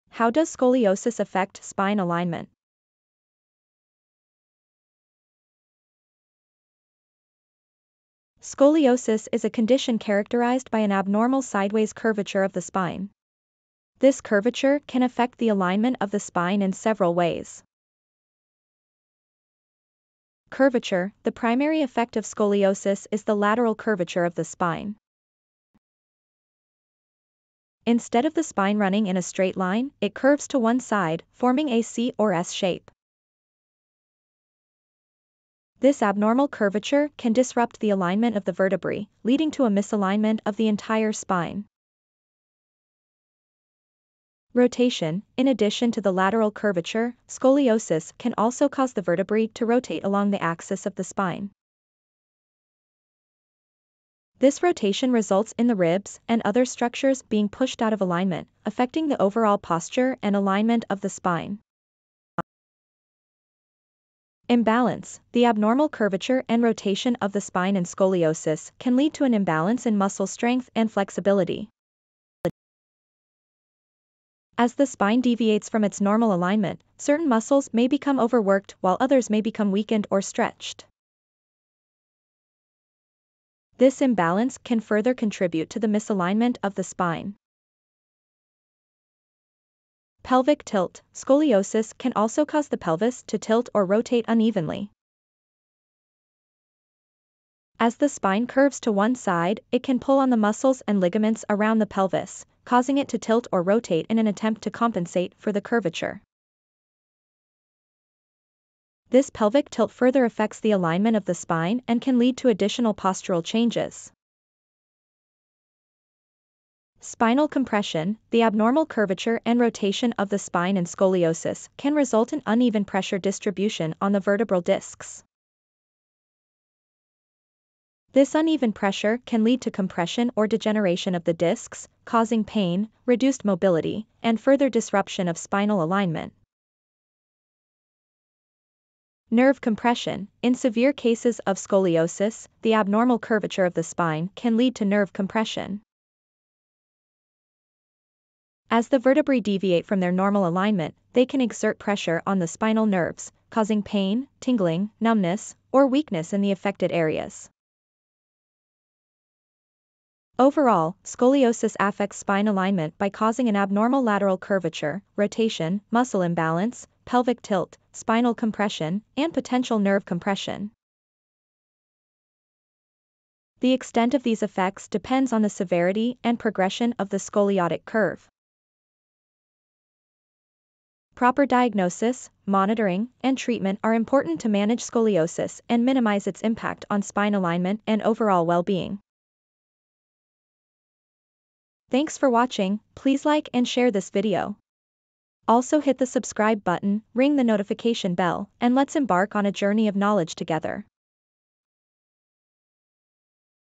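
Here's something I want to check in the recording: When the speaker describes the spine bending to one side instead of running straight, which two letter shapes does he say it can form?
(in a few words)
C or S.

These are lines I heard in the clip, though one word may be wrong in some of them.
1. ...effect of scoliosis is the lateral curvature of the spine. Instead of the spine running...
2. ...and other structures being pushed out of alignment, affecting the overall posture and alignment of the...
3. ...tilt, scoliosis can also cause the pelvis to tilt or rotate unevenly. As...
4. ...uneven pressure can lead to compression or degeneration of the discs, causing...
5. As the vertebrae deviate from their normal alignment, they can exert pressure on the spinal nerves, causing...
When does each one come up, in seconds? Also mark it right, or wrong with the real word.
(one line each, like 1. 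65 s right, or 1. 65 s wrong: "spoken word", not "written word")
1. 21 s right
2. 56 s right
3. 90 s right
4. 128 s right
5. 148 s right.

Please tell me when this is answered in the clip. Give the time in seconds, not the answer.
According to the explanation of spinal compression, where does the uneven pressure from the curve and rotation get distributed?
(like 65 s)
124 s.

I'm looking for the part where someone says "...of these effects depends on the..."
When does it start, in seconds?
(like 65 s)
174 s.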